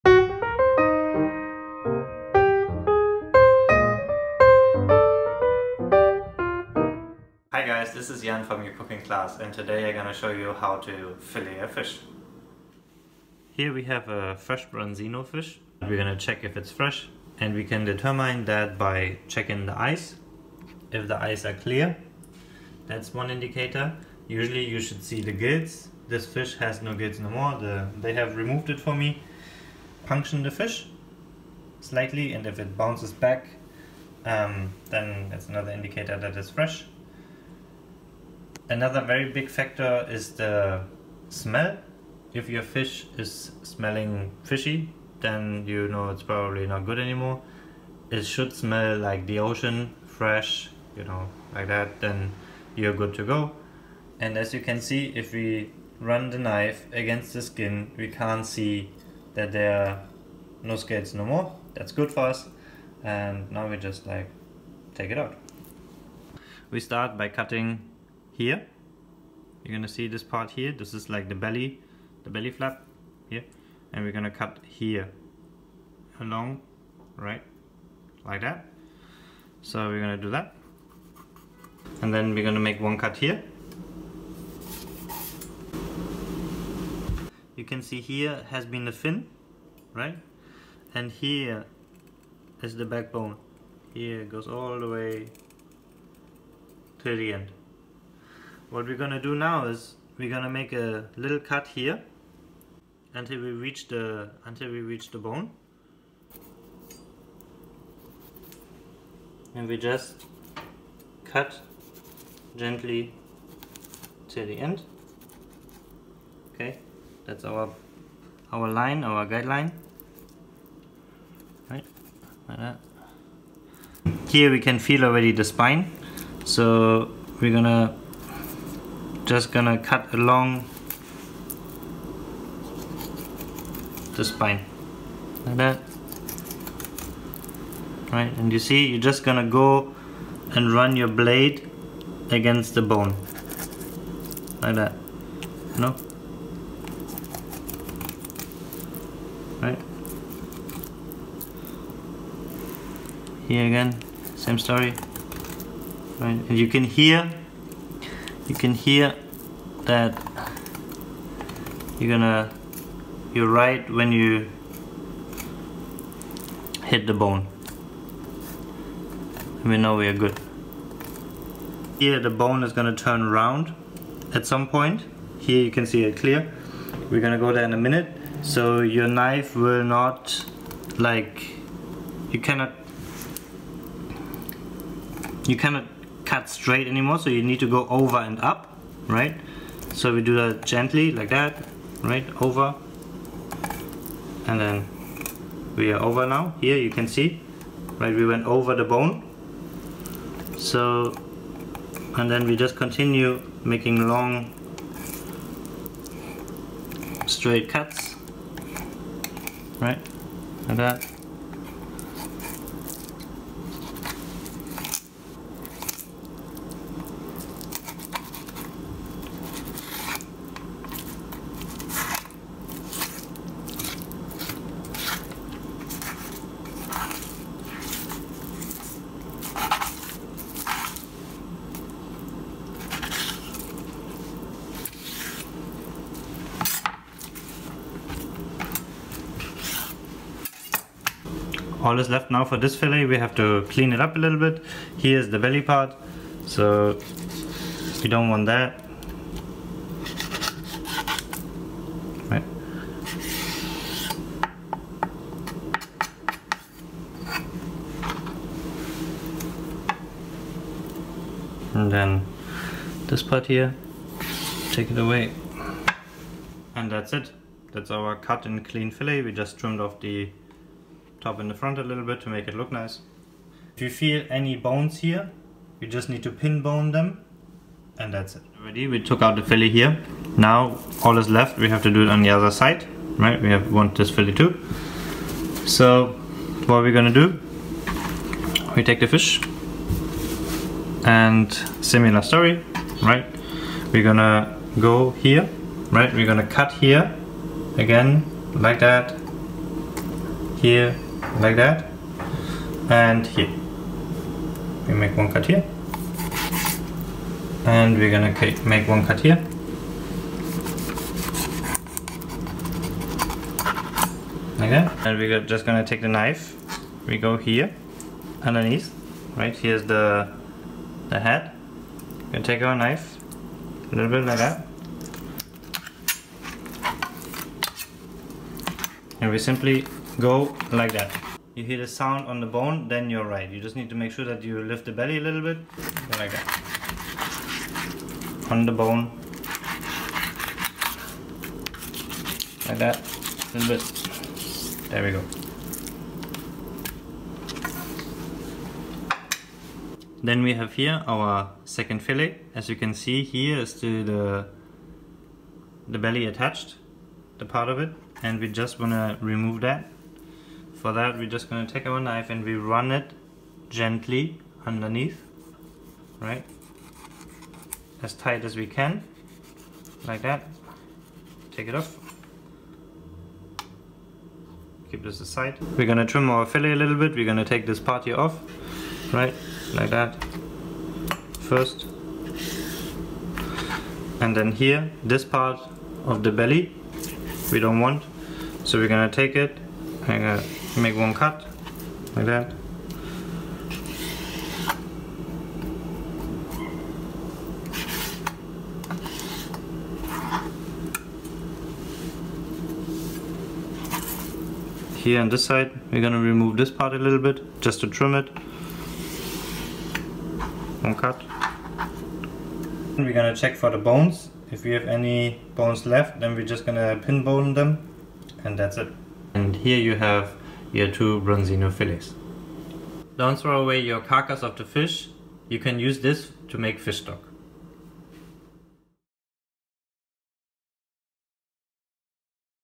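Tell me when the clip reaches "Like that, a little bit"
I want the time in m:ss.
5:42.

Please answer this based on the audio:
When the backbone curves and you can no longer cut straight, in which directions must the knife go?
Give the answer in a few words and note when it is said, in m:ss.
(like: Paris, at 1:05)
Over and up, at 3:07.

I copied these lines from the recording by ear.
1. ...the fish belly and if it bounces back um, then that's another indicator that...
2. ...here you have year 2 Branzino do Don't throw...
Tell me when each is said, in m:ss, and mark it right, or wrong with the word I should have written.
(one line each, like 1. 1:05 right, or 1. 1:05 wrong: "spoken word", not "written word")
1. 0:30 wrong: "slightly", not "belly"
2. 6:59 right.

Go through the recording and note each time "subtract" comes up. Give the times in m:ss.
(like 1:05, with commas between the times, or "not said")
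not said.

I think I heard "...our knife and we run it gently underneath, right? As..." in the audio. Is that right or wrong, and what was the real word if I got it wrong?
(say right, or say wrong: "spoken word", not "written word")
right.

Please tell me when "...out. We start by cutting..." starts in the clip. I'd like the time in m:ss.
1:05.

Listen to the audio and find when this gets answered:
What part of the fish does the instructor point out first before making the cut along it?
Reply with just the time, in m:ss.
1:12.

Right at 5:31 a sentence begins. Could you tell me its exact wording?
You hear the sound on the bone, then you're right.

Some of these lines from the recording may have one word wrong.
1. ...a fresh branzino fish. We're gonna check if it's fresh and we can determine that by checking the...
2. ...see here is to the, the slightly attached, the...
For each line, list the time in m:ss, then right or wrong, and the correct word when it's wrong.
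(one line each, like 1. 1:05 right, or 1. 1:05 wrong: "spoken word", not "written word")
1. 0:14 right
2. 5:52 wrong: "belly", not "slightly".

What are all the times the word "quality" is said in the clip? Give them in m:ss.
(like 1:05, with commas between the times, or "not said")
not said.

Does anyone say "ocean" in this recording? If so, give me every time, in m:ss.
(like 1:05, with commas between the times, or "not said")
0:49.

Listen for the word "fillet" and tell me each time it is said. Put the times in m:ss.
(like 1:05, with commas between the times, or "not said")
0:11, 4:02, 4:28, 4:39, 4:44, 5:52, 6:16.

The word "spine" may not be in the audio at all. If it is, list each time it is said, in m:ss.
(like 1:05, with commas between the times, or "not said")
2:05, 2:14.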